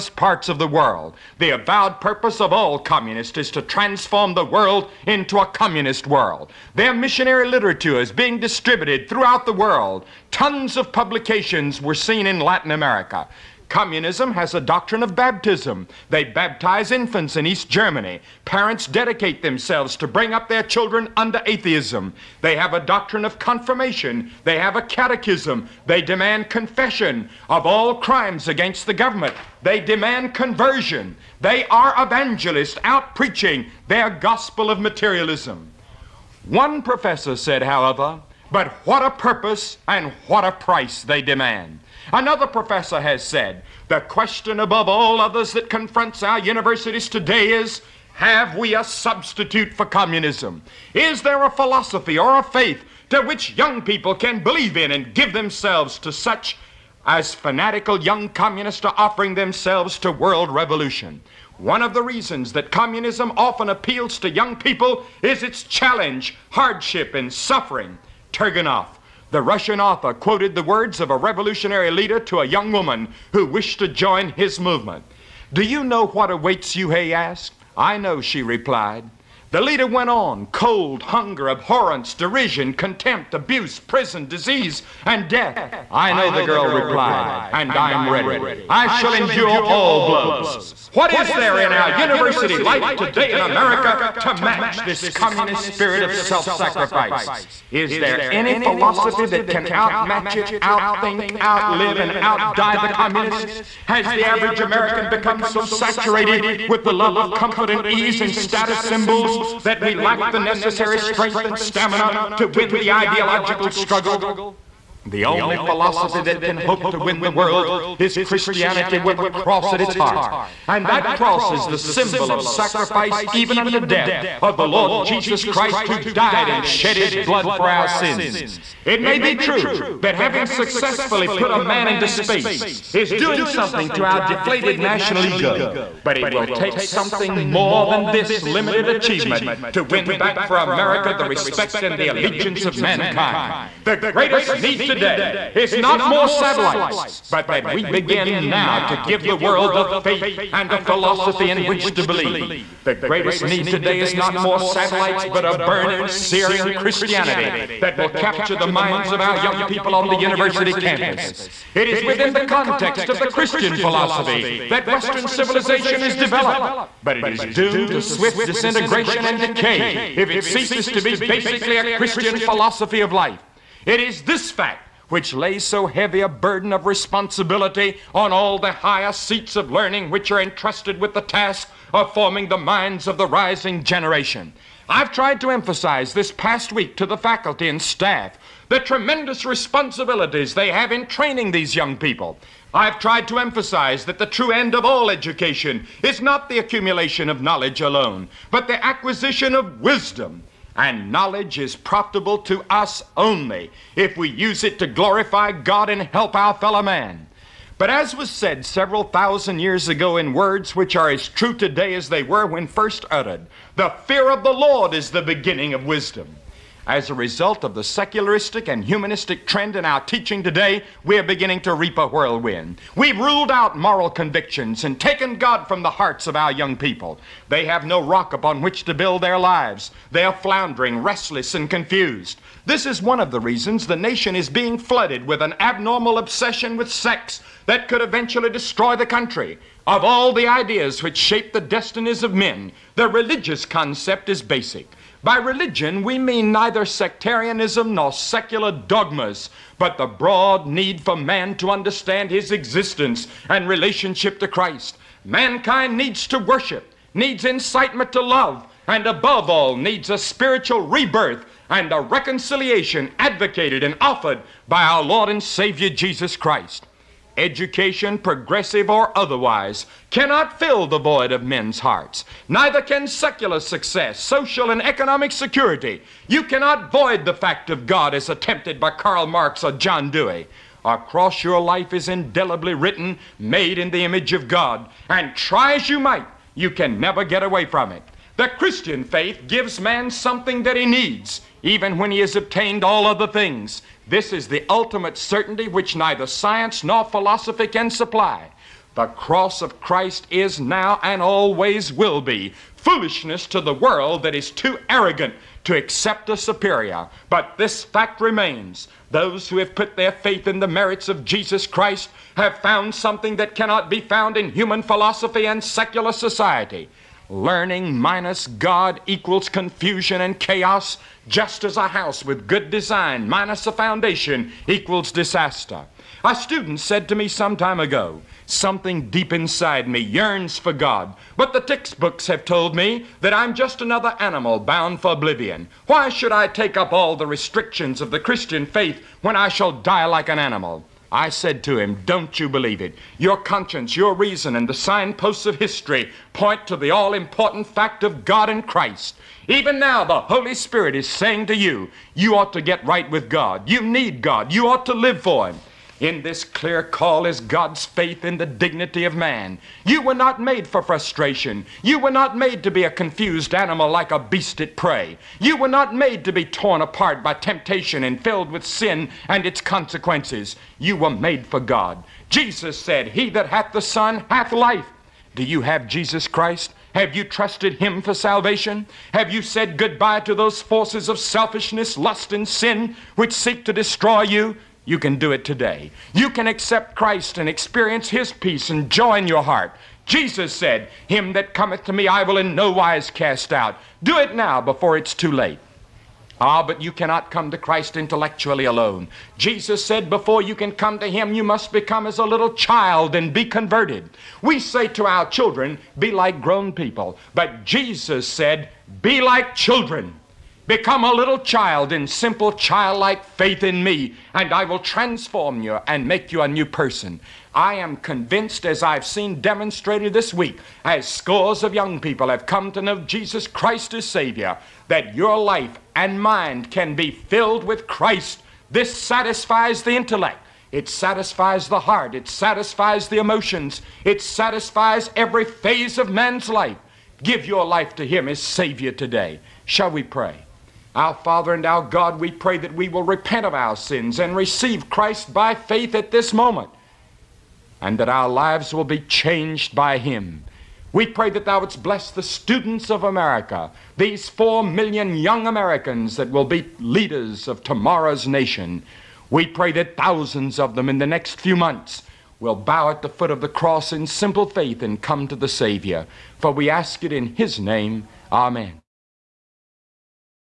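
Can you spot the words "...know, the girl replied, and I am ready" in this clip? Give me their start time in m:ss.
1:26.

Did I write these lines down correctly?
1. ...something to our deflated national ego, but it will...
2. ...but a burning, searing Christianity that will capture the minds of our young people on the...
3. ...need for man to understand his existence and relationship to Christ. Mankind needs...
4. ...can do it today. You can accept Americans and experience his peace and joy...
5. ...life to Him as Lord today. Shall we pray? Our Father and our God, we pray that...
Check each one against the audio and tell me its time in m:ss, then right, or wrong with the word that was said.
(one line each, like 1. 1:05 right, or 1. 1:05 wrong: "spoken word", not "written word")
1. 2:13 right
2. 2:35 right
3. 4:10 right
4. 6:24 wrong: "Christ", not "Americans"
5. 7:17 wrong: "Savior", not "Lord".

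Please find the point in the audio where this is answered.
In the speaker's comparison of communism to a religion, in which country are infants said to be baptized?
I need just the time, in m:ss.
0:17.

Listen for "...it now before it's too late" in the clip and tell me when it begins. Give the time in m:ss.
6:34.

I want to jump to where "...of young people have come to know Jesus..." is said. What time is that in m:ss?
7:01.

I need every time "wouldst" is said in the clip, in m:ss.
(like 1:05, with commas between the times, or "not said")
7:31.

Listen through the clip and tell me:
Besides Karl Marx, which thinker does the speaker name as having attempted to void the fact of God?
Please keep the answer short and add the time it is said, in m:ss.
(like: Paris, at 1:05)
John Dewey, at 4:39.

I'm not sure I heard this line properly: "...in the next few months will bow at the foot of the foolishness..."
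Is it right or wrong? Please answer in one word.
wrong.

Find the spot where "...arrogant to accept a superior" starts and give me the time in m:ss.
5:04.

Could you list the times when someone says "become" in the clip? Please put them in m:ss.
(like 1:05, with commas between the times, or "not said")
1:45, 6:41, 6:50.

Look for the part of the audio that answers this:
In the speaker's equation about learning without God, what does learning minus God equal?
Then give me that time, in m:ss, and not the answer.
5:19.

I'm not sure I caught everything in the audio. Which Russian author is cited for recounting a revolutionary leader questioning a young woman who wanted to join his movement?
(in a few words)
Turgenev.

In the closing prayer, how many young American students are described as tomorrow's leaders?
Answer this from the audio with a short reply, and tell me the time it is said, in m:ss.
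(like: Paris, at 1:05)
4 million, at 7:34.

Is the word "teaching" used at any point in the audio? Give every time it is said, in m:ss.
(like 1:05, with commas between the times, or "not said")
3:39.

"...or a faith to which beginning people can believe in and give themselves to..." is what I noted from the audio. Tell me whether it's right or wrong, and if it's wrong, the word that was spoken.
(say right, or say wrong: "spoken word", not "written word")
wrong: "young", not "beginning".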